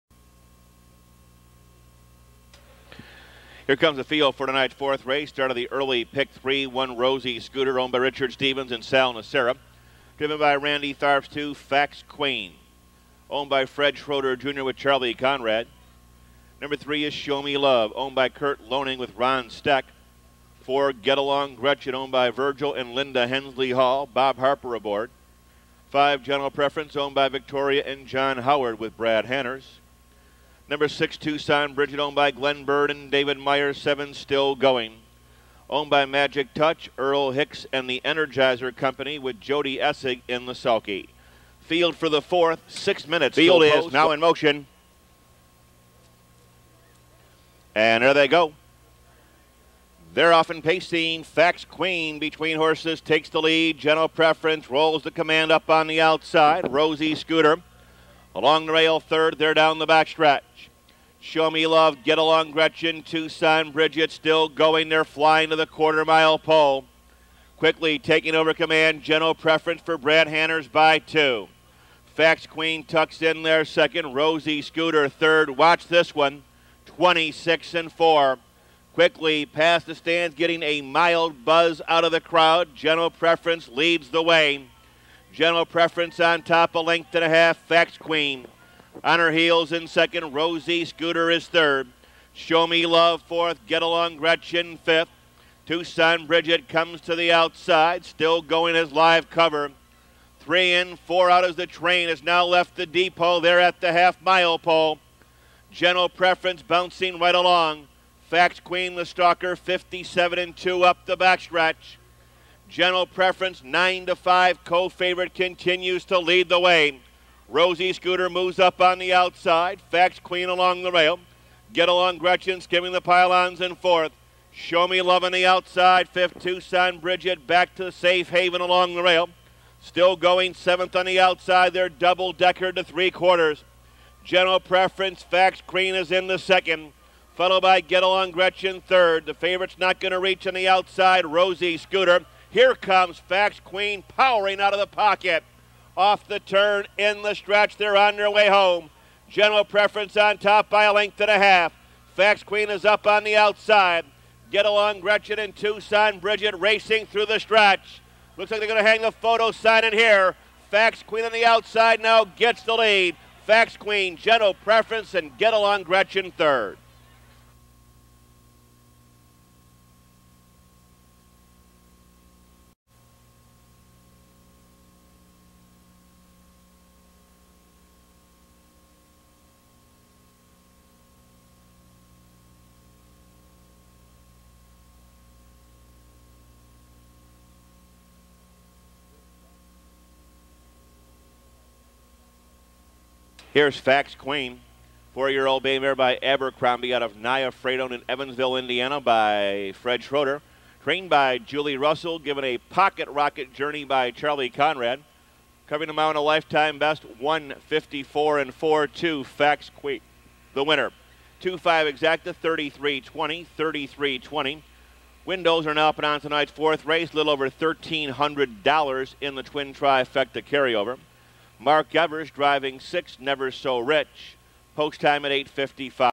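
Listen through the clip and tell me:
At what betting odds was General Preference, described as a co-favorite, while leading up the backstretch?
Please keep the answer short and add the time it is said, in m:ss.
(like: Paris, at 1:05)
9 to 5, at 1:53.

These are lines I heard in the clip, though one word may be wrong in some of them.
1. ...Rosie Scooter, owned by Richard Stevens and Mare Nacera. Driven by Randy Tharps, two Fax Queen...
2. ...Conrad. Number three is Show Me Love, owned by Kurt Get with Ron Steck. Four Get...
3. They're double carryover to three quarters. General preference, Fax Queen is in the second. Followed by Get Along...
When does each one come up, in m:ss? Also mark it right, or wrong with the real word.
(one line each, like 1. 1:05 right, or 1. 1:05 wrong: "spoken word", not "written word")
1. 0:06 wrong: "Sal", not "Mare"
2. 0:15 wrong: "Loning", not "Get"
3. 2:11 wrong: "decker", not "carryover".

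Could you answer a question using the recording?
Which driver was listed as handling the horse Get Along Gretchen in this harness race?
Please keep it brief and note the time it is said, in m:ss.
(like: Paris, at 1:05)
Bob Harper, at 0:24.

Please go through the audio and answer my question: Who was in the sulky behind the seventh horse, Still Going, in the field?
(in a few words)
Jody Essig.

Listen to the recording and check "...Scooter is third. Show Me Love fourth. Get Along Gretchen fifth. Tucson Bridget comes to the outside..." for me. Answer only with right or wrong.
right.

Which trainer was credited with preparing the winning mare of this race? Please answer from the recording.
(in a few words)
Julie Russell.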